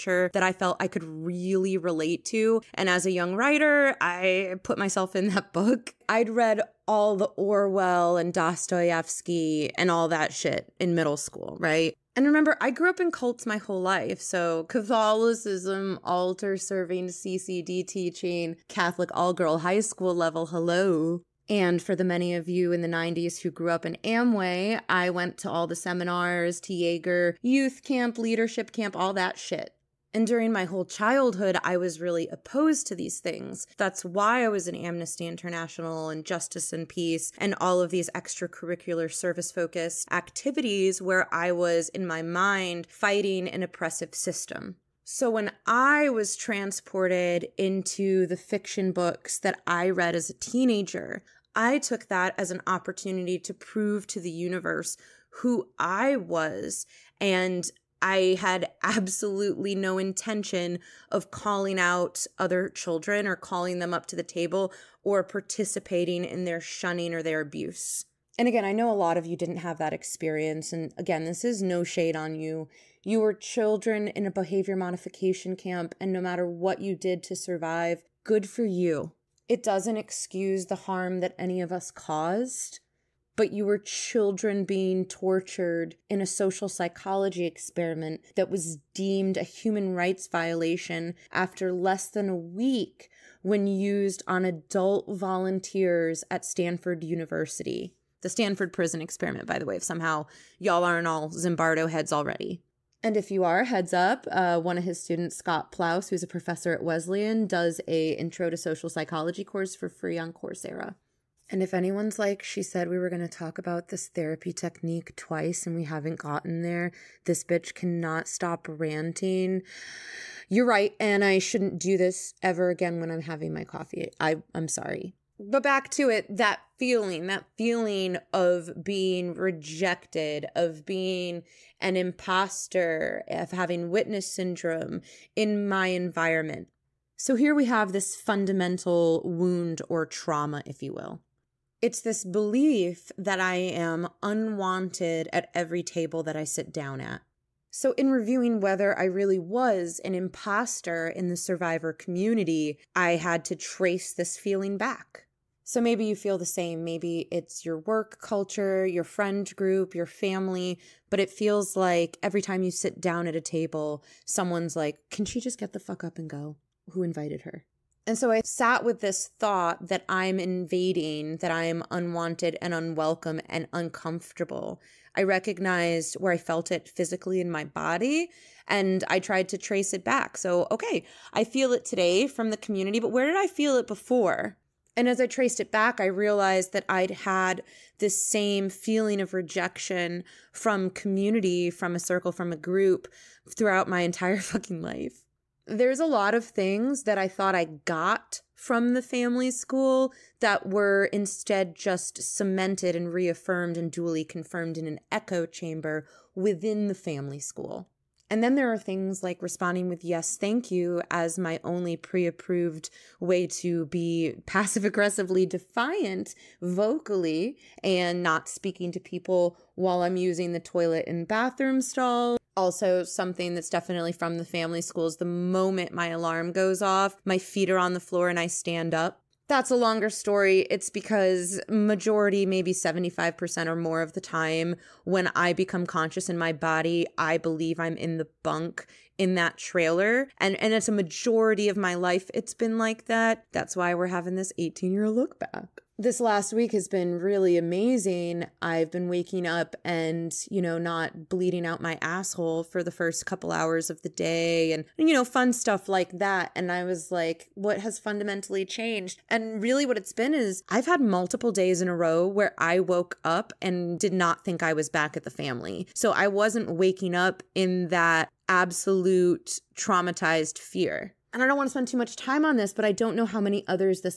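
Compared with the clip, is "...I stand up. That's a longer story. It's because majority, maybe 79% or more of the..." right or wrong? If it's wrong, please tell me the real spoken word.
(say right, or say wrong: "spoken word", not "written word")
wrong: "75", not "79".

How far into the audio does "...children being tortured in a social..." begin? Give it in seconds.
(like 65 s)
83 s.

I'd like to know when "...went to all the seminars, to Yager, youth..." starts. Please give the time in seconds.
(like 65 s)
25 s.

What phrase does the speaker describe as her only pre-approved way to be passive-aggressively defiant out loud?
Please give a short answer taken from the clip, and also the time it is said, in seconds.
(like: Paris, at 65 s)
yes, thank you, at 210 s.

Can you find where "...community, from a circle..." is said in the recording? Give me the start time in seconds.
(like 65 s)
190 s.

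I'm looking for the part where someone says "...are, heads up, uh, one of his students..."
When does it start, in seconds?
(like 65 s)
103 s.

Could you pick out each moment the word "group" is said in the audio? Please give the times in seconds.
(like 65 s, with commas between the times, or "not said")
159 s, 192 s.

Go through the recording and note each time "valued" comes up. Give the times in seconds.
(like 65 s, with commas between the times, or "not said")
not said.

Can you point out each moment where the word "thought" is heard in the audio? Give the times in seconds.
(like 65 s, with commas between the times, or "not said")
169 s, 197 s.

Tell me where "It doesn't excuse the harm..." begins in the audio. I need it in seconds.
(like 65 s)
79 s.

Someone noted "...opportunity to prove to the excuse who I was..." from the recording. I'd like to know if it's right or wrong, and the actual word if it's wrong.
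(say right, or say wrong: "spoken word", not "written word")
wrong: "universe", not "excuse".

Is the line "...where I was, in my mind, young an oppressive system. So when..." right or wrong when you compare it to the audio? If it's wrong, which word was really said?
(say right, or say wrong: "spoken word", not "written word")
wrong: "fighting", not "young".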